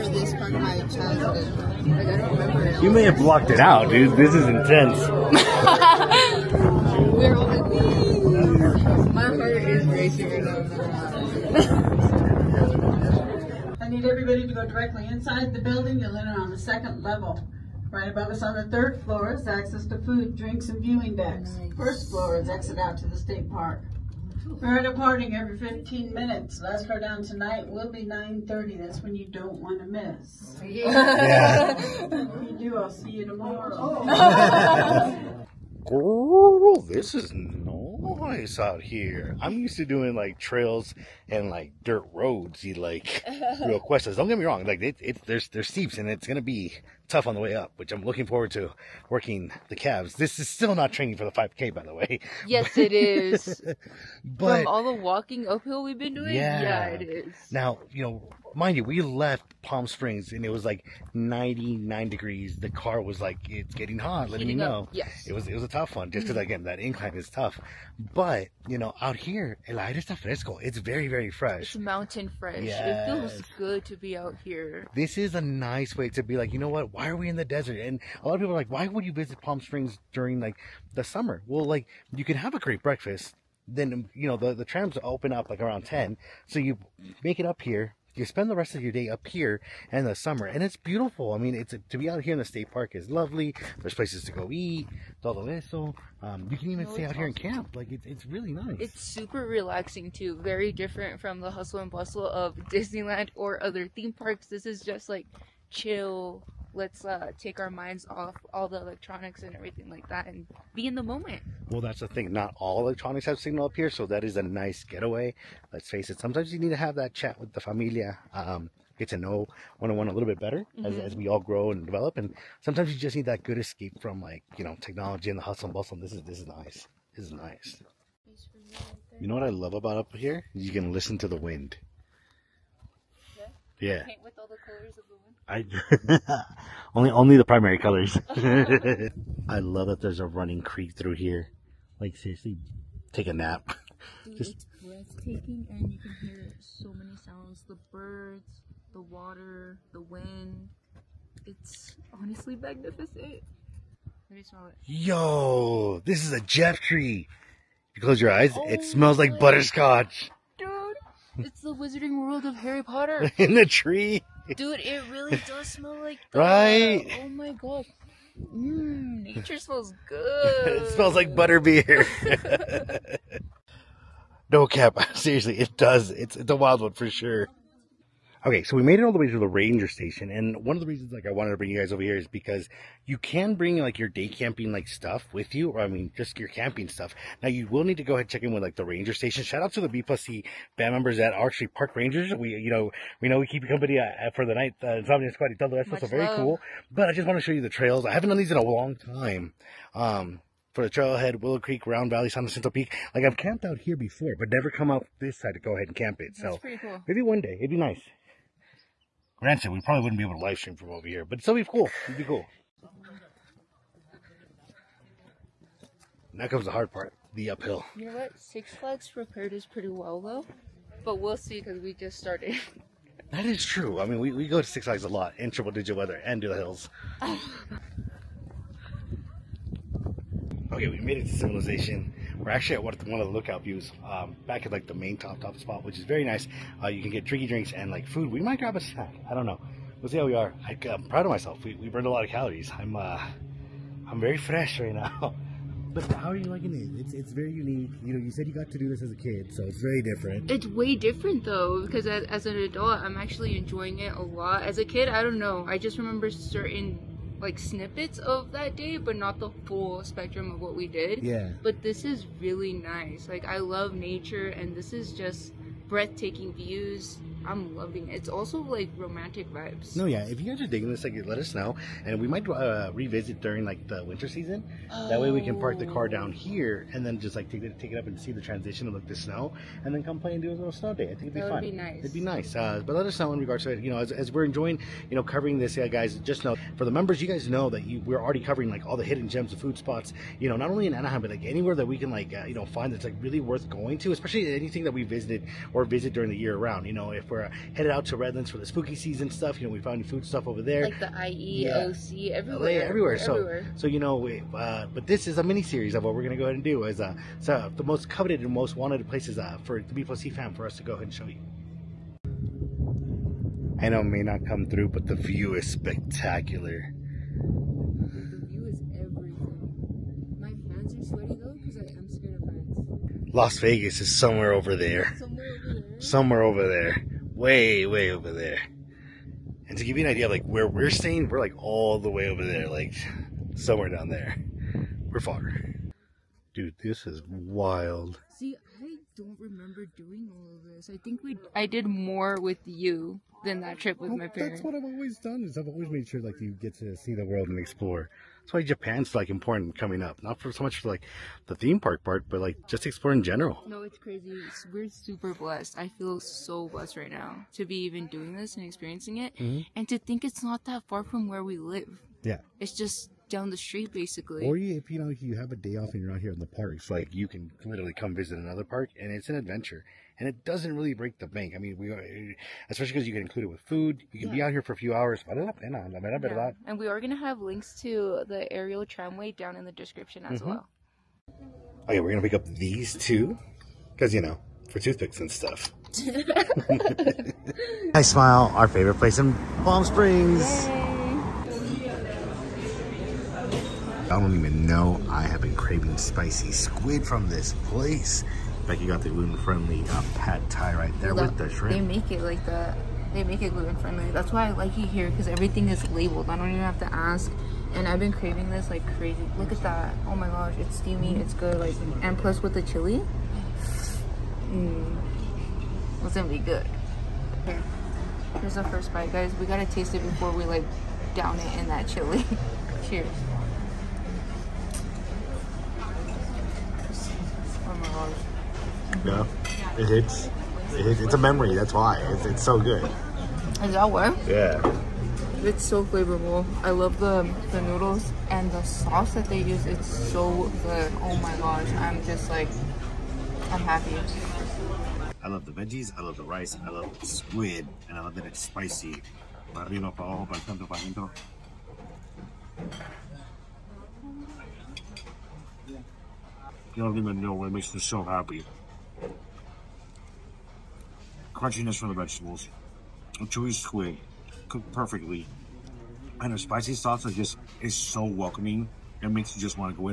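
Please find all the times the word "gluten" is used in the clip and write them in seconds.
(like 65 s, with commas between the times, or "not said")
399 s, 403 s.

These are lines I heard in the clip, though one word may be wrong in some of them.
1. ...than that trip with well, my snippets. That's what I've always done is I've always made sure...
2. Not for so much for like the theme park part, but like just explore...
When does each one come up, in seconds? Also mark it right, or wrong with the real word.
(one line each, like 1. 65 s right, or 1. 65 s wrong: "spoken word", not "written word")
1. 343 s wrong: "parents", not "snippets"
2. 350 s right.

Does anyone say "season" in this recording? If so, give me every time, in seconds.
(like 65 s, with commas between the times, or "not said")
274 s, 298 s.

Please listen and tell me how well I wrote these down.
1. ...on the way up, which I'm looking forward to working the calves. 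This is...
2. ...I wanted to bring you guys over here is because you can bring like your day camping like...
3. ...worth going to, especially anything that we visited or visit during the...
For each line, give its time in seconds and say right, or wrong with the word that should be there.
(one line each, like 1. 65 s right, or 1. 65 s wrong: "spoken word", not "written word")
1. 47 s right
2. 181 s right
3. 293 s right.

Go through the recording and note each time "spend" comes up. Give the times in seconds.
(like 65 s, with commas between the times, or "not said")
88 s.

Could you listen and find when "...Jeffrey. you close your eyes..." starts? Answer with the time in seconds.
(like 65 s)
156 s.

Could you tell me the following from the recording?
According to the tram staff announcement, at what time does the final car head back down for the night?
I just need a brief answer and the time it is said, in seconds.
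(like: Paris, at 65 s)
9:30, at 28 s.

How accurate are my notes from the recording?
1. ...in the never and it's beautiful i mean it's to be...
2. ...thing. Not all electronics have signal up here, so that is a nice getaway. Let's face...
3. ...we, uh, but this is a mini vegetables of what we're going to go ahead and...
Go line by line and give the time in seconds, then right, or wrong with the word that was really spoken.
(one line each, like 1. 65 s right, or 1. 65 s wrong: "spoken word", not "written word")
1. 89 s wrong: "summer", not "never"
2. 112 s right
3. 304 s wrong: "series", not "vegetables".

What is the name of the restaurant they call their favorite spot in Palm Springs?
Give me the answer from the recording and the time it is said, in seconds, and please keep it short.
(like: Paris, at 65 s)
Thai Smile, at 387 s.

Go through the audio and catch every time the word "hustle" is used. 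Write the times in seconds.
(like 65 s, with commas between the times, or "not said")
101 s, 125 s.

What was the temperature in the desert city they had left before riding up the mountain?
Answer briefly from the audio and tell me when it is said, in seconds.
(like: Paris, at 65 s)
99 degrees, at 61 s.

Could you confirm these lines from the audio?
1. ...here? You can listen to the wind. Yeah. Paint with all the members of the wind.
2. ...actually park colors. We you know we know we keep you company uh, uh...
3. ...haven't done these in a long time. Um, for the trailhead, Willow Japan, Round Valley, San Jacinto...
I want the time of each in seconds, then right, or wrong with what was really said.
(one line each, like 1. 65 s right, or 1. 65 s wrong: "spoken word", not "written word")
1. 130 s wrong: "colors", not "members"
2. 191 s wrong: "rangers", not "colors"
3. 198 s wrong: "Creek", not "Japan".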